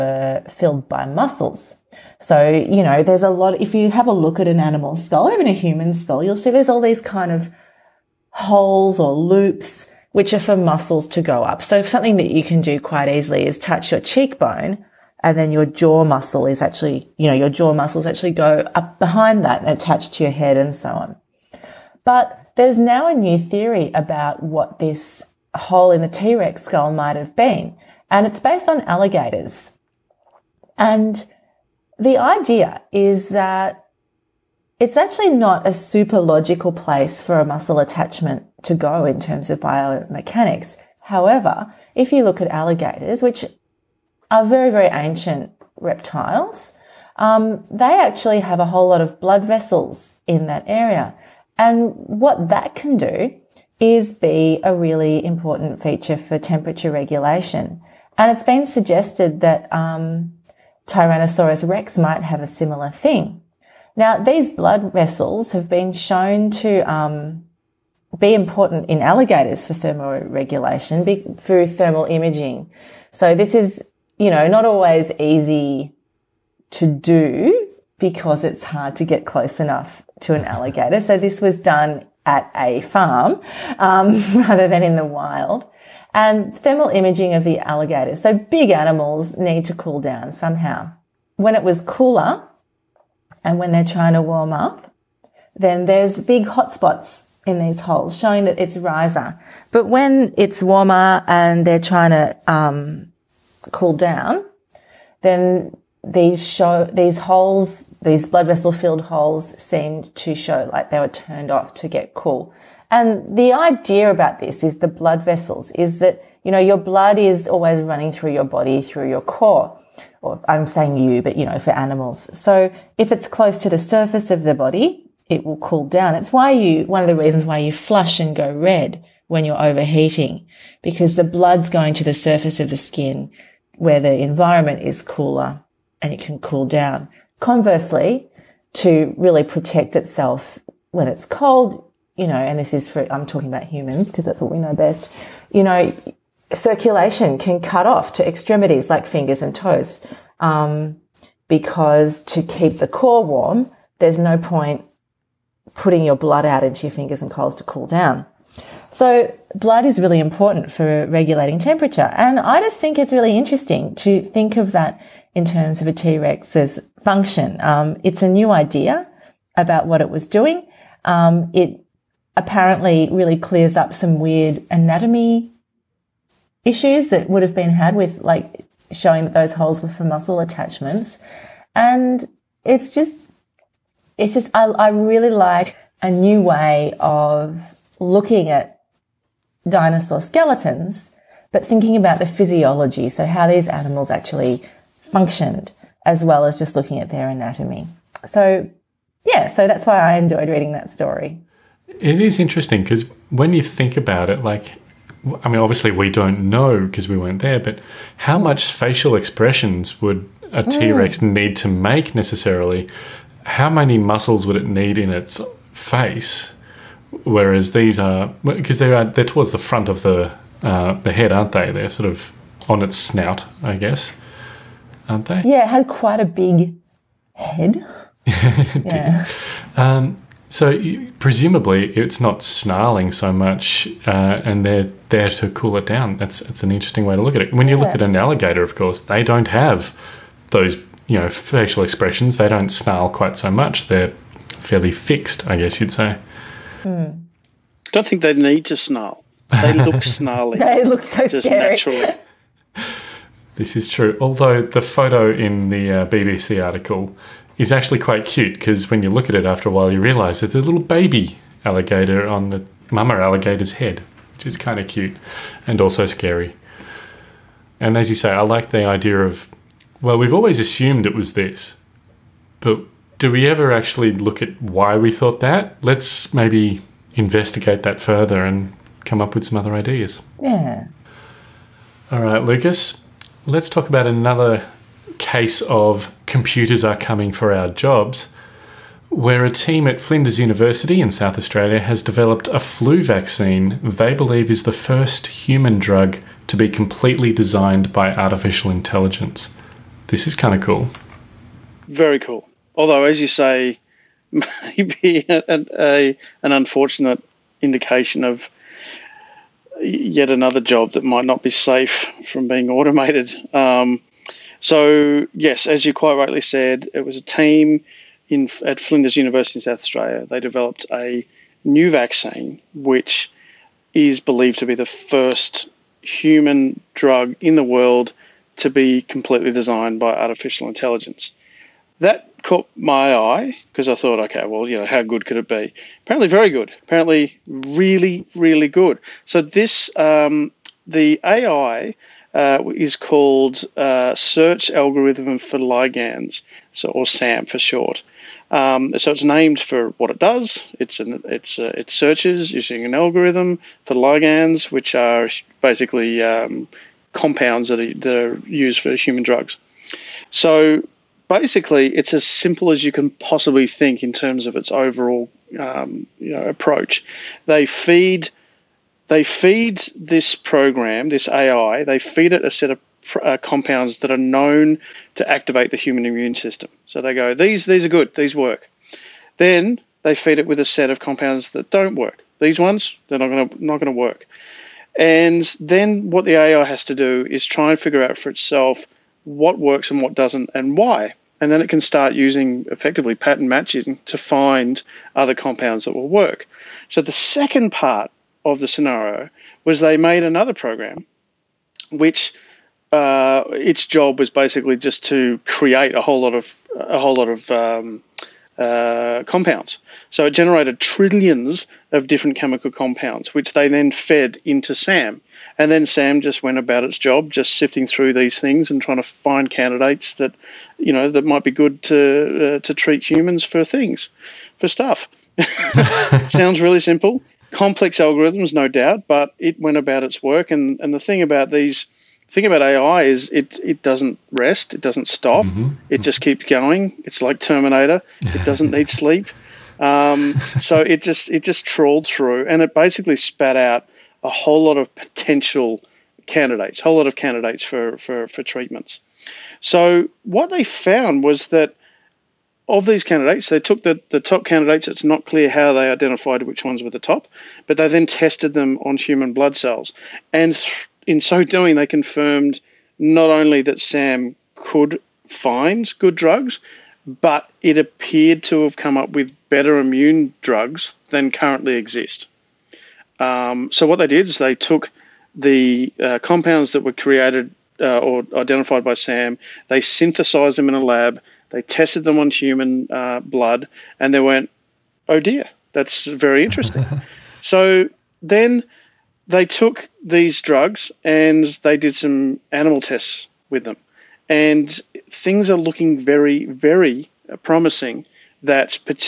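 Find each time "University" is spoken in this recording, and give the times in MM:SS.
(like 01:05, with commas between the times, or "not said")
04:50, 05:19.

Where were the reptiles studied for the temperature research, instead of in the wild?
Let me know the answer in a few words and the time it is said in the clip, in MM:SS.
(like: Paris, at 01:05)
At a farm, at 01:22.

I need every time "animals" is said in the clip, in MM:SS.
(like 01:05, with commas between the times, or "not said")
00:04, 01:28, 02:01, 03:13, 08:12.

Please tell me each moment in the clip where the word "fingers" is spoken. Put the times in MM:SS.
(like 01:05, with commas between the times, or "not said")
02:29, 02:36.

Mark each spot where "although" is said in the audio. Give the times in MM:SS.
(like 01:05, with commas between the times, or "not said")
04:14, 05:02.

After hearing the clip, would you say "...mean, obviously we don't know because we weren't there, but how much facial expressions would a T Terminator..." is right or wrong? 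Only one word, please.
wrong.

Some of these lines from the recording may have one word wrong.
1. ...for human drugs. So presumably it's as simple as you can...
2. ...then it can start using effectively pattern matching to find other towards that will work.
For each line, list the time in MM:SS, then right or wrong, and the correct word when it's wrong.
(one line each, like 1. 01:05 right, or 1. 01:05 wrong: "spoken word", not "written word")
1. 05:58 wrong: "basically", not "presumably"
2. 06:31 wrong: "compounds", not "towards".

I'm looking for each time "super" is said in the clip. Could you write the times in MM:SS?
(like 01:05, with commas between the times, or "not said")
00:35.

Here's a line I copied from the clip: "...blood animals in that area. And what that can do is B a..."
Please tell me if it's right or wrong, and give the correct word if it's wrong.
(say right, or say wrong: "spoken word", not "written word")
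wrong: "vessels", not "animals".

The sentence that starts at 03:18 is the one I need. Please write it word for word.
So, yeah, so that's why I enjoyed reading that story.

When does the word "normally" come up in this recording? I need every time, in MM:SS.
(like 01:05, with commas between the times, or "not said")
not said.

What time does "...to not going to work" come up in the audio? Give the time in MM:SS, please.
06:23.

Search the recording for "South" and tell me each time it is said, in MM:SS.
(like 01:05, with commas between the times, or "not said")
04:51, 05:19.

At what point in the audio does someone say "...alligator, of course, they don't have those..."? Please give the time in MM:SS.
03:58.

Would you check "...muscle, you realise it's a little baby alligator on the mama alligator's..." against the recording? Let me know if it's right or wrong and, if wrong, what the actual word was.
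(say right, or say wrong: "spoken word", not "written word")
wrong: "while", not "muscle".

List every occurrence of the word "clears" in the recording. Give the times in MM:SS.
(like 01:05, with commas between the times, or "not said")
02:53, 07:35.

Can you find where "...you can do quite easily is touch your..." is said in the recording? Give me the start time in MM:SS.
00:12.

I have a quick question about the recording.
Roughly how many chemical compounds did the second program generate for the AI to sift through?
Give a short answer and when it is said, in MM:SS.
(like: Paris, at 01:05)
Trillions, at 06:50.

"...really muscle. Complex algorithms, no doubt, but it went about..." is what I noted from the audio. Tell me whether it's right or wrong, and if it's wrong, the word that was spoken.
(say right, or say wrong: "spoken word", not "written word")
wrong: "simple", not "muscle".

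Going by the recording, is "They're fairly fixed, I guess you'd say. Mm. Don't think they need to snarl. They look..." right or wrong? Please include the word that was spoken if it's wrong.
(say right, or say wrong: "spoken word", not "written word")
right.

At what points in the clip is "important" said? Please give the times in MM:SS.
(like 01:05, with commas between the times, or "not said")
00:55, 01:08, 02:40.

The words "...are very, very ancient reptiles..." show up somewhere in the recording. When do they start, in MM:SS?
00:44.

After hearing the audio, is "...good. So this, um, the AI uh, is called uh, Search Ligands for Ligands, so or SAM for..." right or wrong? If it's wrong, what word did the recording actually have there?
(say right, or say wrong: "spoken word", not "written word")
wrong: "Algorithm", not "Ligands".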